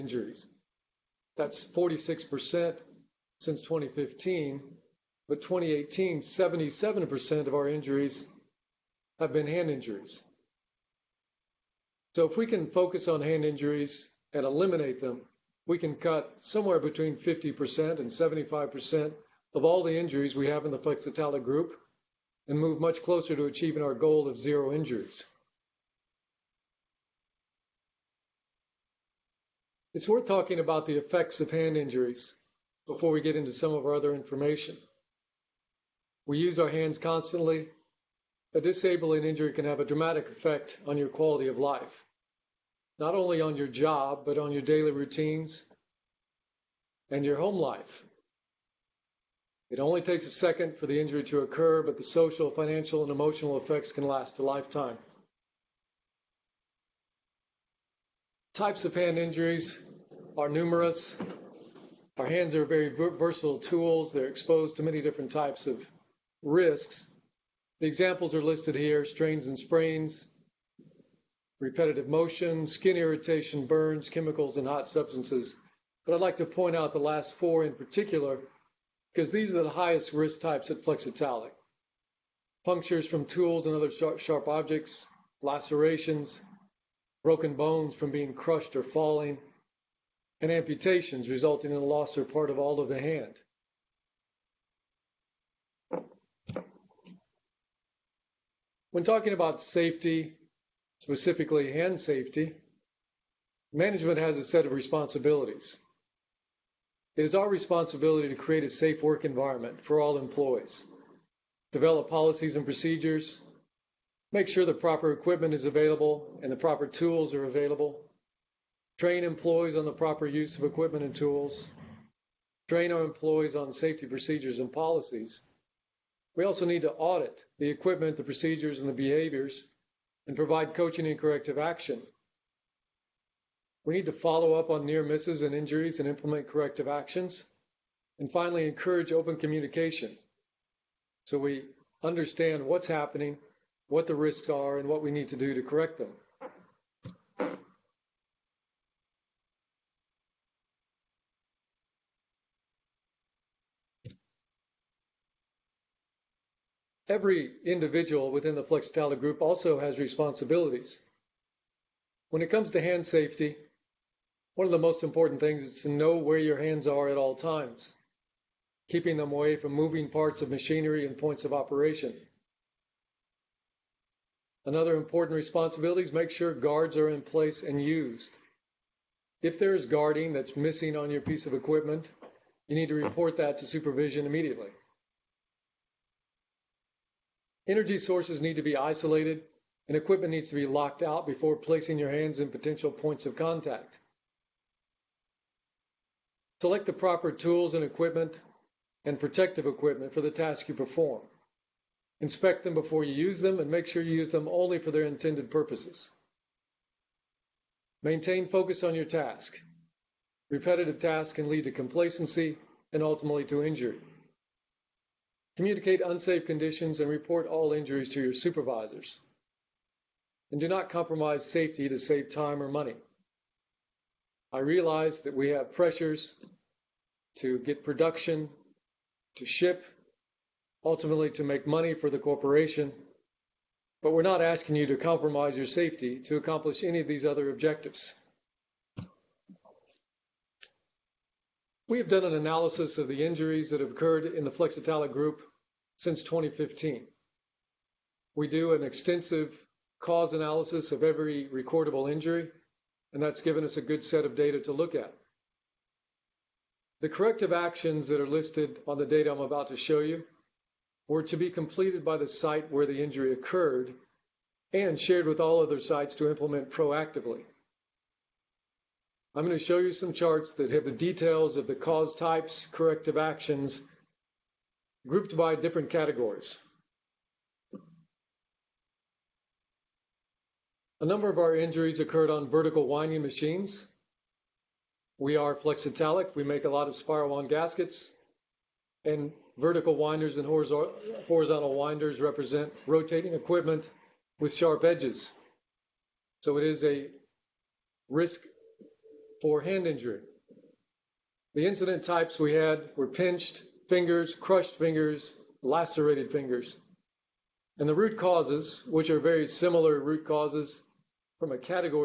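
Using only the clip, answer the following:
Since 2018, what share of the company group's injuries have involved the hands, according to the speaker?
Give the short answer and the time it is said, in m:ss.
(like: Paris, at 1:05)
77%, at 0:06.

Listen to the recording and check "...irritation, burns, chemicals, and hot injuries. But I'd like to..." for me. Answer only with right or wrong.
wrong.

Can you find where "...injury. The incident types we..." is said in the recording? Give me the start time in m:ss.
4:59.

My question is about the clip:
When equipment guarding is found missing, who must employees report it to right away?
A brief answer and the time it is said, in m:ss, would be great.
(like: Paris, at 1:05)
Supervision, at 3:03.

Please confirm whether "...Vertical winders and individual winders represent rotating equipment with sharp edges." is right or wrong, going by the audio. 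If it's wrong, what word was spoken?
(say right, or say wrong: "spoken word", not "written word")
wrong: "horizontal", not "individual".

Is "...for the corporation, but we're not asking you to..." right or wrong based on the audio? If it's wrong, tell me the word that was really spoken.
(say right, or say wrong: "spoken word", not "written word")
right.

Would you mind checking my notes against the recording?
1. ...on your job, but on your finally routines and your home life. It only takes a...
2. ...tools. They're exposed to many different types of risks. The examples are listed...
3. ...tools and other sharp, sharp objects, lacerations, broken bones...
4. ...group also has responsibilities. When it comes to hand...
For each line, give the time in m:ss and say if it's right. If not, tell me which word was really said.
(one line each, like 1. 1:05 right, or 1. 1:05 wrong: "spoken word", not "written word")
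1. 0:43 wrong: "daily", not "finally"
2. 1:03 right
3. 1:23 right
4. 2:39 right.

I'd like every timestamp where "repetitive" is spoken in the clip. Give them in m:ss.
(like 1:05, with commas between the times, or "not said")
1:11, 3:30.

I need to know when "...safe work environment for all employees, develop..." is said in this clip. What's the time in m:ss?
1:48.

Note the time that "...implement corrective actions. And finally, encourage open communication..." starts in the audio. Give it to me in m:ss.
2:16.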